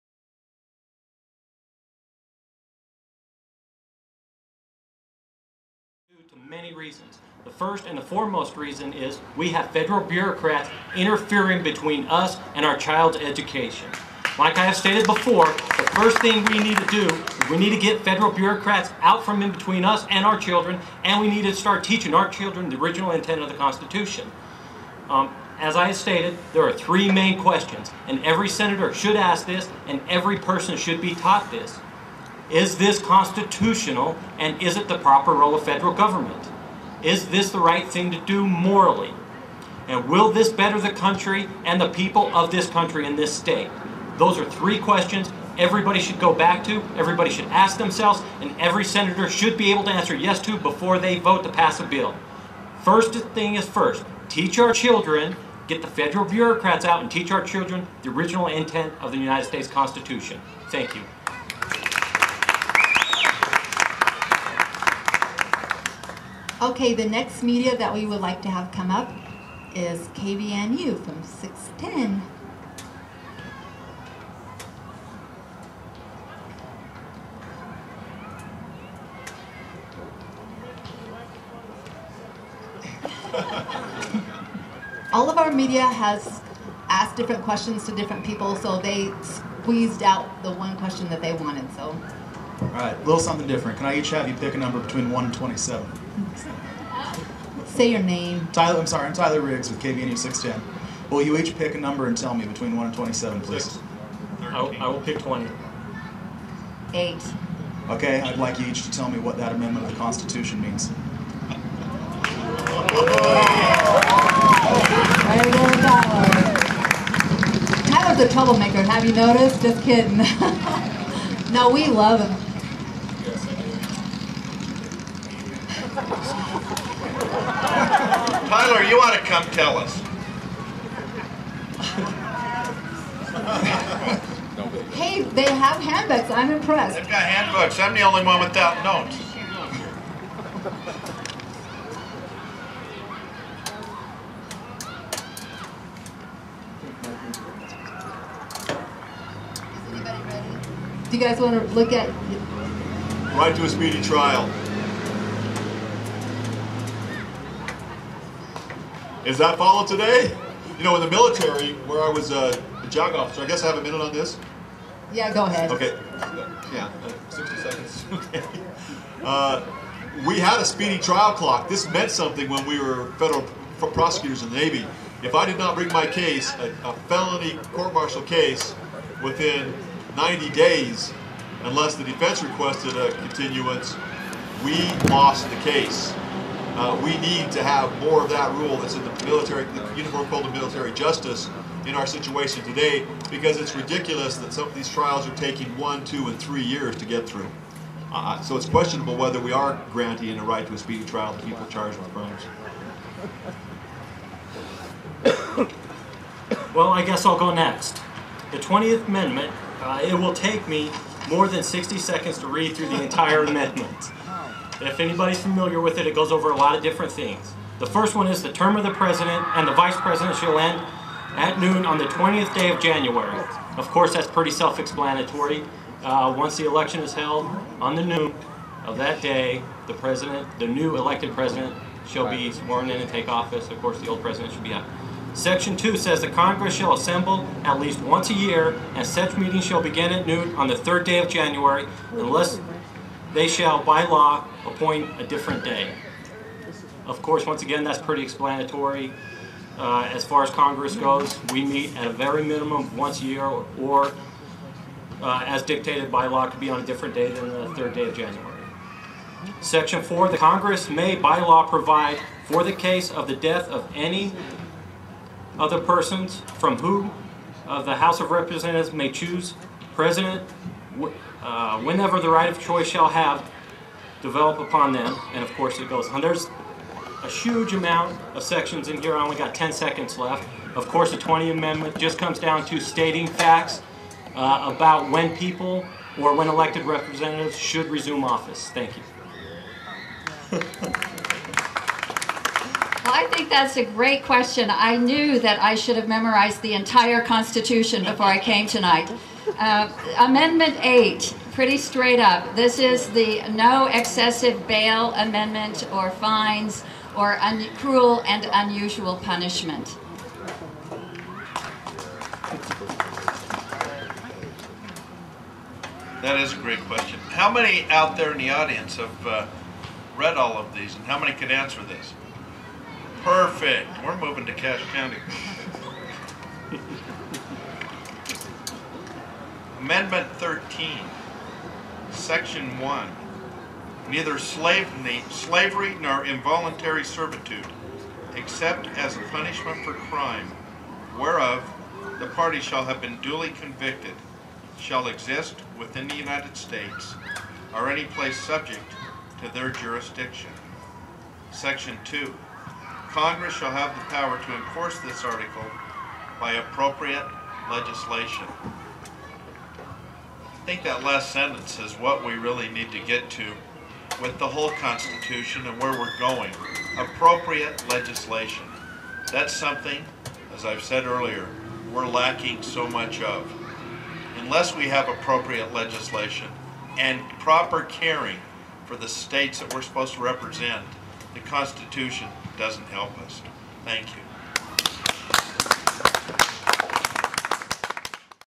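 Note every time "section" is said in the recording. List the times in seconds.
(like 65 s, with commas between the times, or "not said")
235 s, 259 s, 278 s, 332 s, 351 s.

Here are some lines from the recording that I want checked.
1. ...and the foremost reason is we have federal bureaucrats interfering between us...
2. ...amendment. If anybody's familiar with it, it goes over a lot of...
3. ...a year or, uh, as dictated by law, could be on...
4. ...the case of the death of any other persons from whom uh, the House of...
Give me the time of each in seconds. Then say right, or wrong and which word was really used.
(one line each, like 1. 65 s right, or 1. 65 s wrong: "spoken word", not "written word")
1. 7 s right
2. 213 s right
3. 253 s right
4. 262 s right.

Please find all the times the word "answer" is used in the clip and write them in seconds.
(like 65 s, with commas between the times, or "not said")
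49 s, 321 s.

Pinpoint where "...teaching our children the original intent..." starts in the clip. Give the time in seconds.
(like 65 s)
21 s.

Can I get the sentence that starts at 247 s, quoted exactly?
Of course, once again, that's pretty explanatory.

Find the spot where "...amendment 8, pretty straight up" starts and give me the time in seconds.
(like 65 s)
300 s.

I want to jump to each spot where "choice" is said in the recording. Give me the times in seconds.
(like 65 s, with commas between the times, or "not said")
272 s.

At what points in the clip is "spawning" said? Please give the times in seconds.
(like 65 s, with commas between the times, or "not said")
not said.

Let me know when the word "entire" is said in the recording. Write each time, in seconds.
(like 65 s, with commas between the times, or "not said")
213 s, 296 s.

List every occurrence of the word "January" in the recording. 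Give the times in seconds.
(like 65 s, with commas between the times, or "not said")
222 s, 241 s, 258 s.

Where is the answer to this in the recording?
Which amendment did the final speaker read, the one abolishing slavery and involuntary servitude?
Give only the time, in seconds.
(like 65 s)
329 s.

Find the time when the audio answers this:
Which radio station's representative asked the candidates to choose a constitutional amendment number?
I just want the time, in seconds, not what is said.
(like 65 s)
70 s.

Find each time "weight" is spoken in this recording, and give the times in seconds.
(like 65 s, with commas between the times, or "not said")
not said.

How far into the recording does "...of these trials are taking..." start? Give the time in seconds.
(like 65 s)
194 s.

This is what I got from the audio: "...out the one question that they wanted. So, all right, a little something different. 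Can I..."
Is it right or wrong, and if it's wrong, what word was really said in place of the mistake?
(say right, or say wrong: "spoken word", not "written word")
right.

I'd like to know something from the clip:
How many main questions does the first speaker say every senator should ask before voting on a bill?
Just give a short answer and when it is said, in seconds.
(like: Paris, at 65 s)
3, at 26 s.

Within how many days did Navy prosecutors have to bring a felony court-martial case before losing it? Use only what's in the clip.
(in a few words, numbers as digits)
90.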